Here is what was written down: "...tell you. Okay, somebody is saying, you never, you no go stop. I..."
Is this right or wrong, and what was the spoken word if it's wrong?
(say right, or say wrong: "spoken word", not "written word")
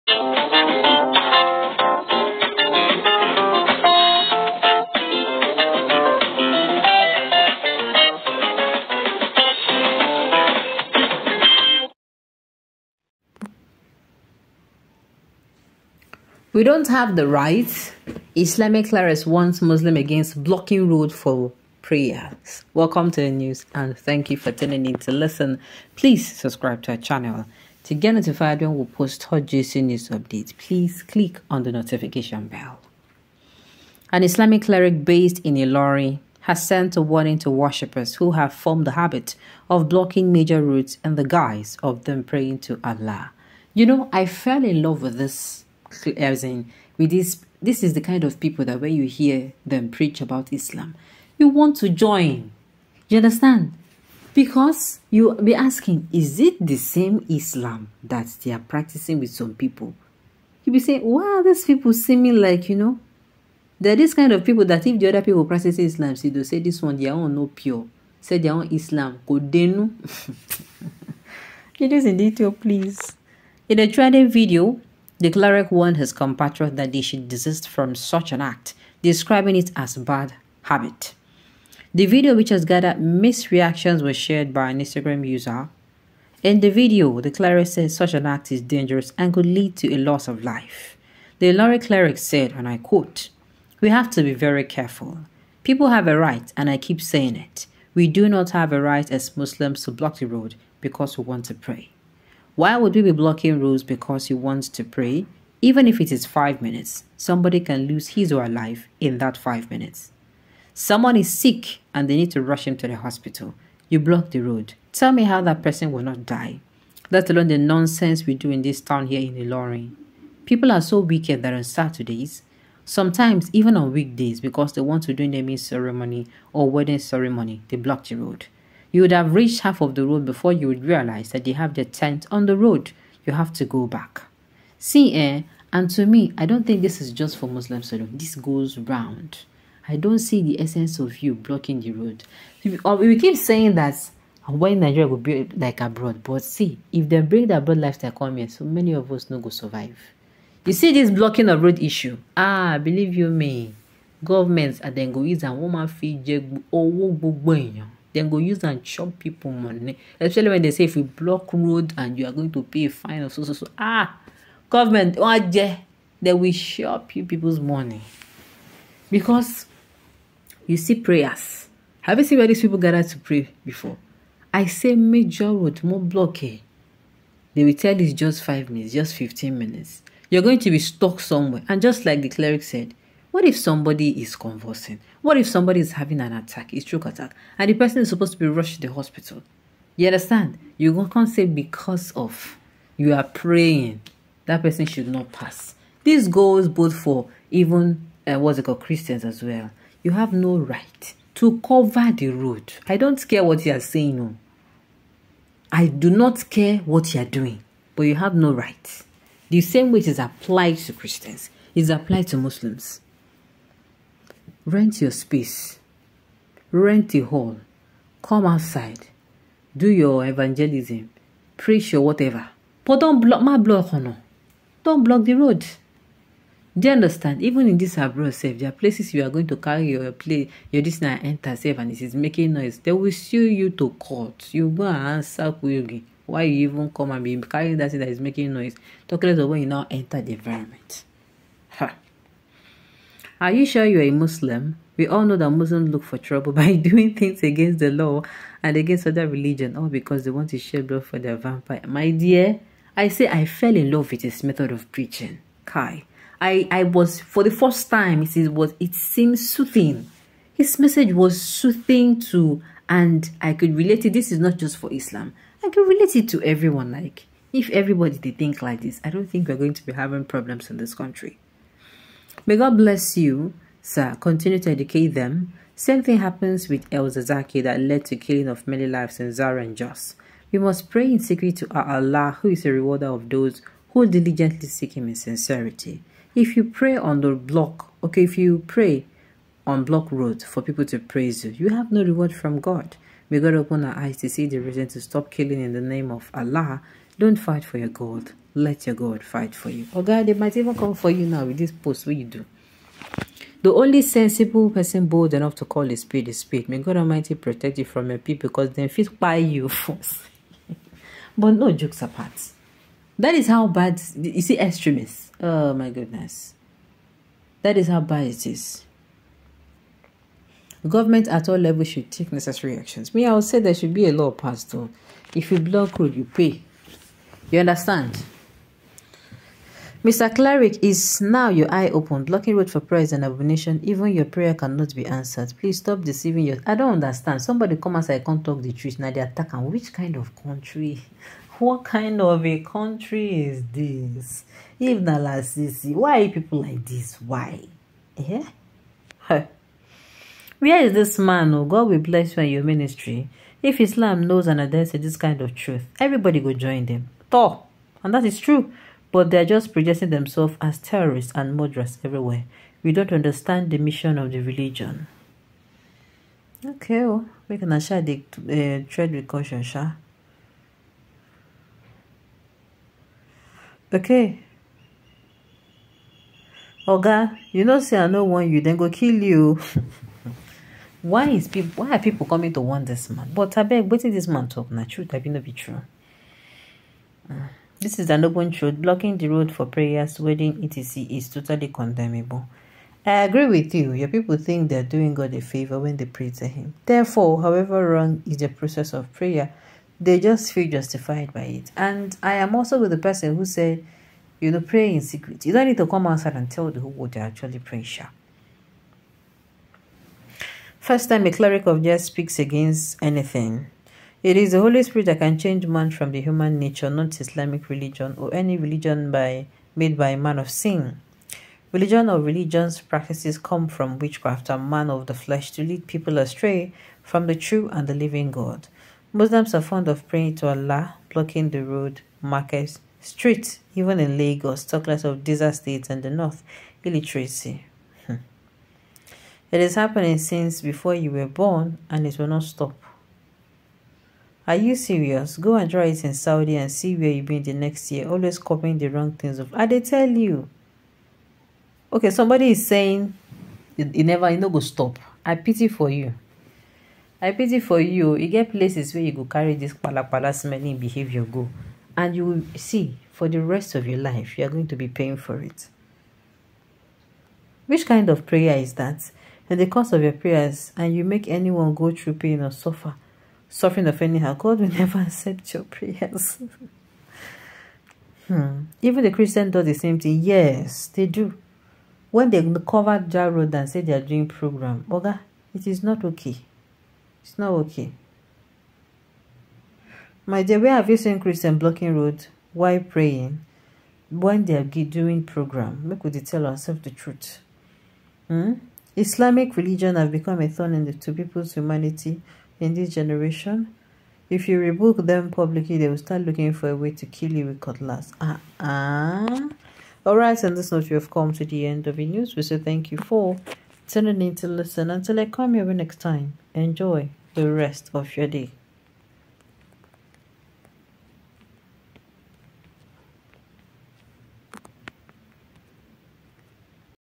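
right.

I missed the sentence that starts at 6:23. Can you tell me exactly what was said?
But I beg, what is this man talk na truth, I be no be true.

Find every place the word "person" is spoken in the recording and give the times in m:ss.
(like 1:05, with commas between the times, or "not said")
1:55, 3:07, 3:14, 5:04, 6:42.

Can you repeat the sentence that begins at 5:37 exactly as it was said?
Somebody come I can't talk the truth.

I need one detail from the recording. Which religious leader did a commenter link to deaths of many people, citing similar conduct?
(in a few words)
El-Zakzaky.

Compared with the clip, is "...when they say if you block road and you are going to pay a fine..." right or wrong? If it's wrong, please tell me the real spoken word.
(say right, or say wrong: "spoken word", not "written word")
right.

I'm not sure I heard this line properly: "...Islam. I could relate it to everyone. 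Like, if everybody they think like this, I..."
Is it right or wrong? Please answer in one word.
right.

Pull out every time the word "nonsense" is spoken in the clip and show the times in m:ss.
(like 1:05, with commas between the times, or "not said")
1:57.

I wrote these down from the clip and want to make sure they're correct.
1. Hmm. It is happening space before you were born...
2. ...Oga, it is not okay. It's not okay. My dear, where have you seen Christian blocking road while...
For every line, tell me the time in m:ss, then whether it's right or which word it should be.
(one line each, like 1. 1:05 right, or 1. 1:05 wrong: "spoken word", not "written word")
1. 7:18 wrong: "since", not "space"
2. 8:04 right.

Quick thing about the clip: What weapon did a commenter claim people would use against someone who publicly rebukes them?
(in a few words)
Cutlass.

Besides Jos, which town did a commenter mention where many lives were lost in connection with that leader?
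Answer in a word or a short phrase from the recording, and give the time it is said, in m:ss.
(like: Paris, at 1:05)
Zaria, at 4:39.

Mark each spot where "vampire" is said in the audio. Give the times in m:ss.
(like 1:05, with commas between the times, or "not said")
4:11.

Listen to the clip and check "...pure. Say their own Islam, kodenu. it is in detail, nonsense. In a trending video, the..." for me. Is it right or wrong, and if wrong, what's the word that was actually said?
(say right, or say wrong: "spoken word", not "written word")
wrong: "please", not "nonsense".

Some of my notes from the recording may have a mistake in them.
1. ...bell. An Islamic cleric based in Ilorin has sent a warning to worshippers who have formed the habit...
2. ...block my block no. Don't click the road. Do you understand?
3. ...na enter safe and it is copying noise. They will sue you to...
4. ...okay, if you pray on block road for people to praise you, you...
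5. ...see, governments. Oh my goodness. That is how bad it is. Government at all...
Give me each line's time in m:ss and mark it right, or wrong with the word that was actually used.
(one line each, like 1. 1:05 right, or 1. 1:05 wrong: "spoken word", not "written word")
1. 0:32 right
2. 3:43 wrong: "block", not "click"
3. 3:51 wrong: "making", not "copying"
4. 4:48 right
5. 5:14 wrong: "extremists", not "governments".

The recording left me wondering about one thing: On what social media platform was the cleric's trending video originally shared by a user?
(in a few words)
Instagram.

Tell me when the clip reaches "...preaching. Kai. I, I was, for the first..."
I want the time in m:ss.
4:14.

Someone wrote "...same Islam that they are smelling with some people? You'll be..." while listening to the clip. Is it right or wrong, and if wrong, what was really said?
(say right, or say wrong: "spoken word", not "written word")
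wrong: "practicing", not "smelling".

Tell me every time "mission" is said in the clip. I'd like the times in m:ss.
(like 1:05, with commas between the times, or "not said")
6:03.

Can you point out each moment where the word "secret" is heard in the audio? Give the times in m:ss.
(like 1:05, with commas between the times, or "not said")
4:41, 6:45.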